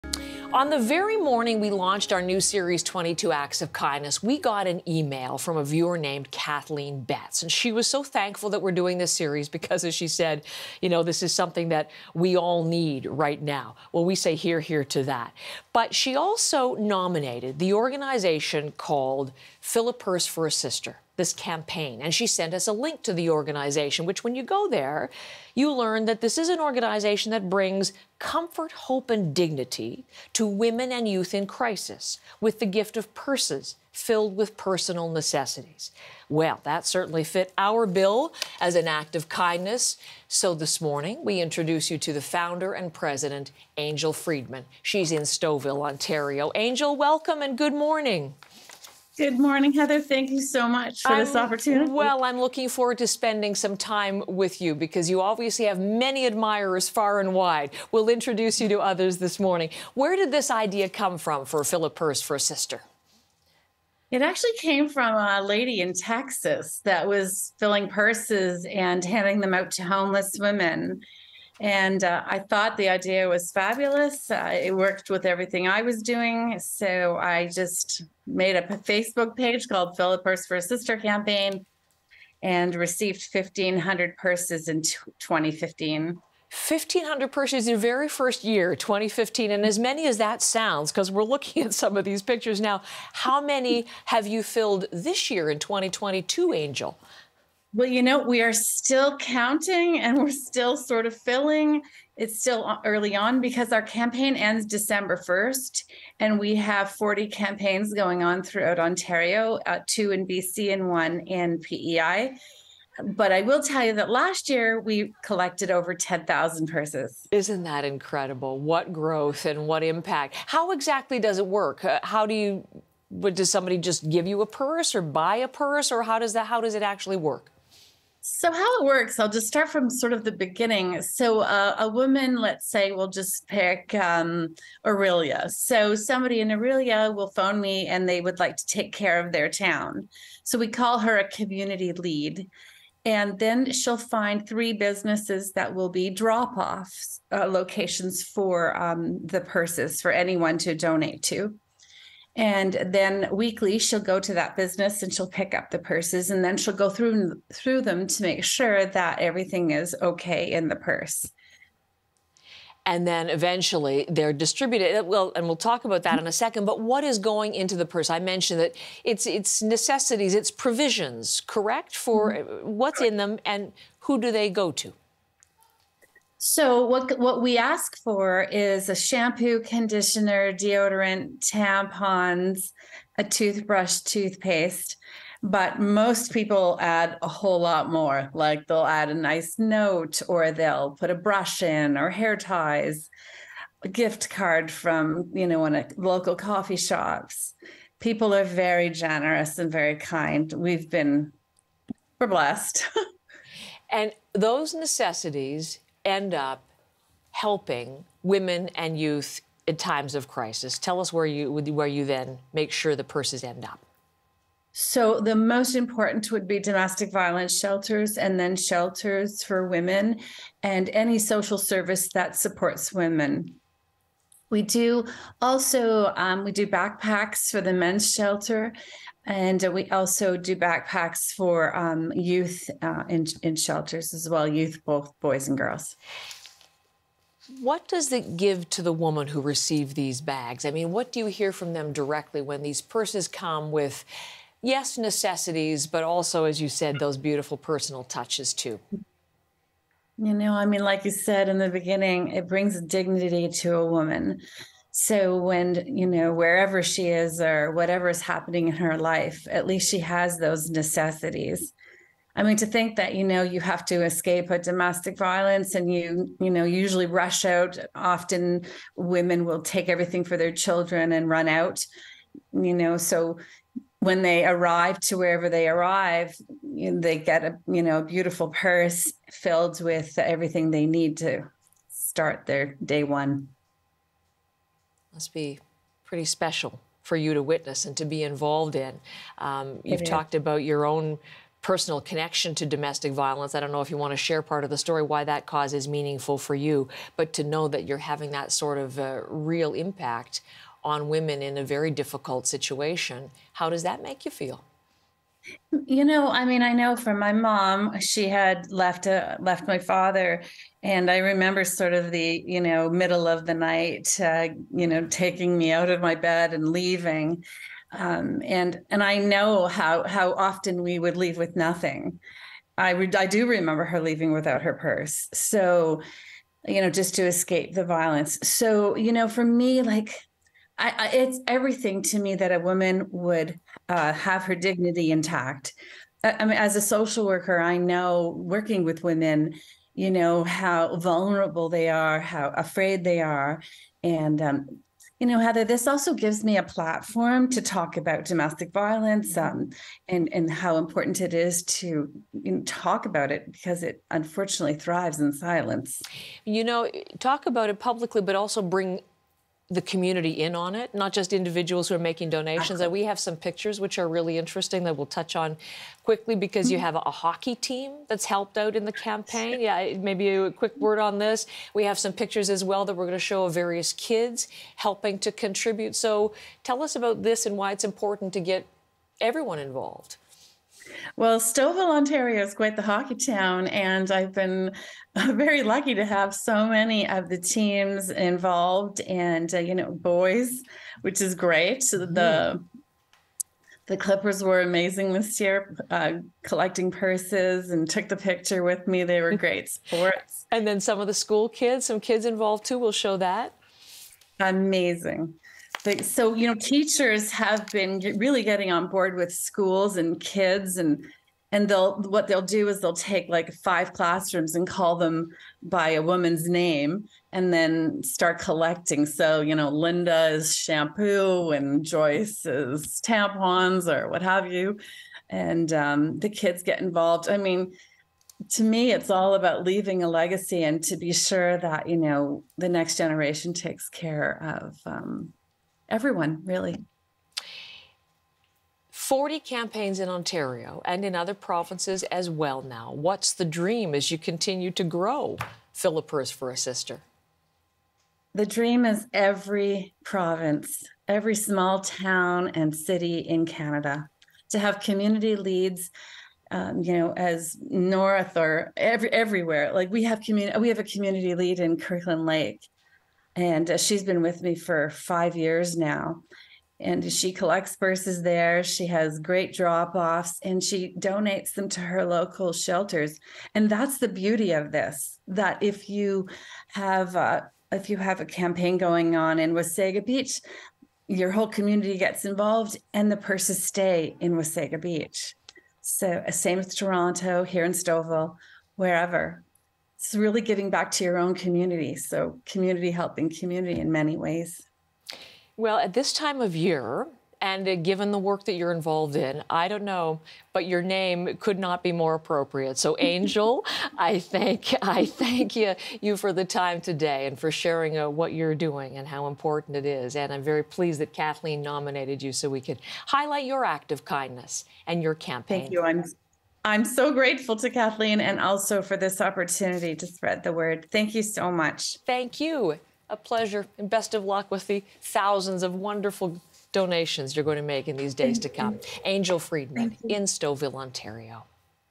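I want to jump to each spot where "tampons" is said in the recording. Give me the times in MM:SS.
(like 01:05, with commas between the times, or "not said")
03:01, 07:03.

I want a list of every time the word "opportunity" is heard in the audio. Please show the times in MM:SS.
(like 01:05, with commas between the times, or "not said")
00:51, 08:39.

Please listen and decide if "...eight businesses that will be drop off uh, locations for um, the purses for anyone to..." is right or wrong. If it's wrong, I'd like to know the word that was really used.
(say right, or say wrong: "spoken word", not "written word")
wrong: "three", not "eight".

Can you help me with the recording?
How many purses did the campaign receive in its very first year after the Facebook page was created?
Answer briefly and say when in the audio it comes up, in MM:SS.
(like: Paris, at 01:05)
1,500, at 01:23.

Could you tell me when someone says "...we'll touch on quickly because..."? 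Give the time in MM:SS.
06:04.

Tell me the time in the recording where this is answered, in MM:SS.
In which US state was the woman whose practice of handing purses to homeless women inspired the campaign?
01:05.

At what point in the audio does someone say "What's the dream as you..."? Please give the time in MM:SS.
07:22.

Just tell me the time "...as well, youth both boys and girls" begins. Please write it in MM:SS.
03:54.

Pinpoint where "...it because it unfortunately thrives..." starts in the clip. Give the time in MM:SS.
05:53.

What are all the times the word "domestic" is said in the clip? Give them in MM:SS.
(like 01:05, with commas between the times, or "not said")
03:36, 04:24, 04:52, 05:48.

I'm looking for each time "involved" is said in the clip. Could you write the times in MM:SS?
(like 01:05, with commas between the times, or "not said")
04:48, 06:19, 06:28, 06:42, 07:06, 08:02, 08:18.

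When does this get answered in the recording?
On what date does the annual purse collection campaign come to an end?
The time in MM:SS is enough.
01:44.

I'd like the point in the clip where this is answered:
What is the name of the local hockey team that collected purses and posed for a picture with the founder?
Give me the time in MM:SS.
06:32.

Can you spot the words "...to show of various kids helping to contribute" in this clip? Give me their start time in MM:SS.
06:13.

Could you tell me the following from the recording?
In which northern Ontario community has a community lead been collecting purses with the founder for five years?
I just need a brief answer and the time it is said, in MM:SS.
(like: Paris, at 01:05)
Kirkland Lake, at 07:41.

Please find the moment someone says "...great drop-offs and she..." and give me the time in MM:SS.
07:49.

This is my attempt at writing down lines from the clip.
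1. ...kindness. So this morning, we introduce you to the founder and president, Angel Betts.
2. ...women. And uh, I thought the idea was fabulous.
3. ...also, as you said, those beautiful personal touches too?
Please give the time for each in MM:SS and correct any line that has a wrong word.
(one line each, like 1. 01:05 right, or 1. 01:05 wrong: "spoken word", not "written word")
1. 00:39 wrong: "Freedman", not "Betts"
2. 01:10 right
3. 04:06 right.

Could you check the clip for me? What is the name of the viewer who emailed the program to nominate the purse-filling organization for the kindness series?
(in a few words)
Kathleen Betts.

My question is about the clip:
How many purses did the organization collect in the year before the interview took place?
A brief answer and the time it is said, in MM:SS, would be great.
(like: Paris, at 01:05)
over 10,000, at 01:55.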